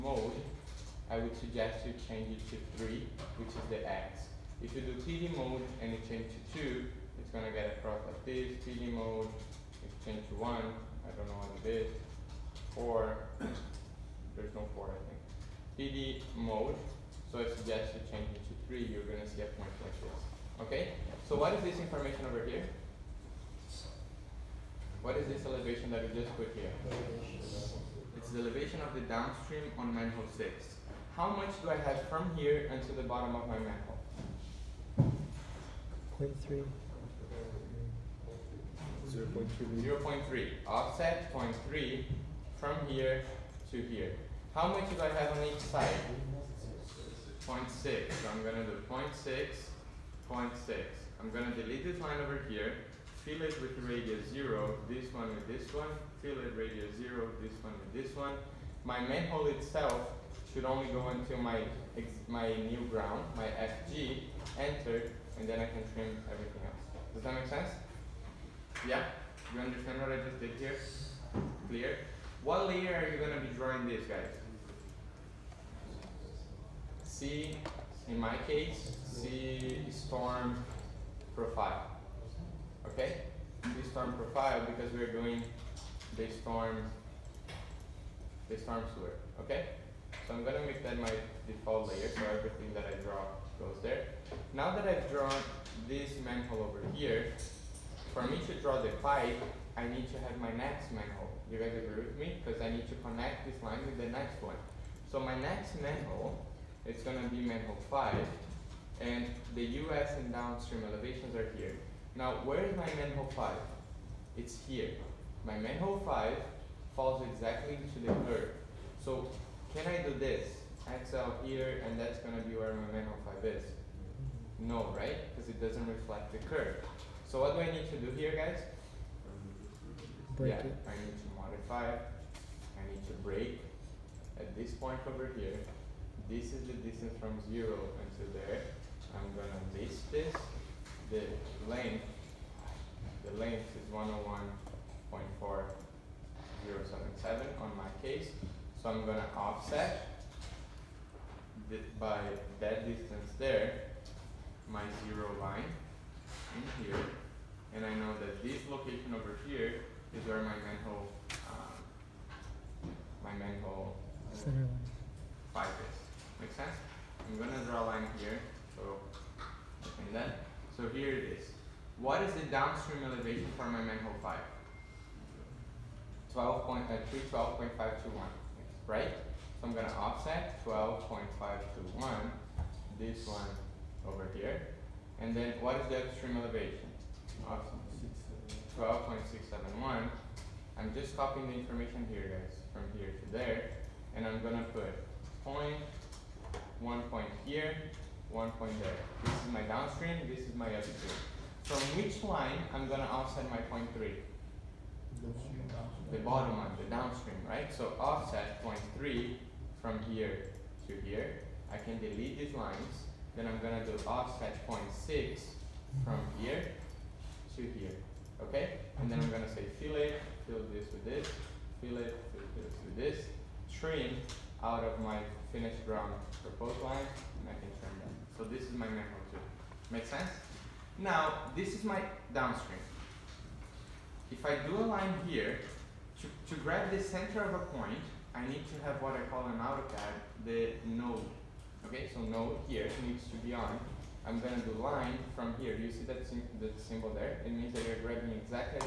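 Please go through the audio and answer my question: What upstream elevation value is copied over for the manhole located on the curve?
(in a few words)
12.671.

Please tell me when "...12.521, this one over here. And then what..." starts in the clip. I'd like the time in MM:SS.
03:00.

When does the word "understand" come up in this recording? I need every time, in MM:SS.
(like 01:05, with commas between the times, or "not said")
01:09.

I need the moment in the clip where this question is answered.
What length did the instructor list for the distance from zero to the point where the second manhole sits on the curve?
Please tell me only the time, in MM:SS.
02:23.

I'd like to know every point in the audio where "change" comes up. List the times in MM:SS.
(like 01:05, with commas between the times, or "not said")
00:02, 00:06, 00:10, 00:18.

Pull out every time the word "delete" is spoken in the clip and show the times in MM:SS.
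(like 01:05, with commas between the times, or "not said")
00:51, 03:31.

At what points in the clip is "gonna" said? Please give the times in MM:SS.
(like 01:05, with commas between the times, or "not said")
01:30, 02:19, 02:29, 03:22, 03:33, 03:39, 04:04.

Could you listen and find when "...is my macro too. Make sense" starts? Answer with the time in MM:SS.
03:48.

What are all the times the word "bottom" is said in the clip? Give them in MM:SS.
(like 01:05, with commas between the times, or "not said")
00:33, 03:26.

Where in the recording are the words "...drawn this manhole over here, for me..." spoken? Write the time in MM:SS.
01:35.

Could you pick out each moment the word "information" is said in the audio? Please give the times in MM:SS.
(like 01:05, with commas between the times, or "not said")
00:21, 03:11.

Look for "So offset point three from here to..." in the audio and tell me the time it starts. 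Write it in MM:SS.
03:27.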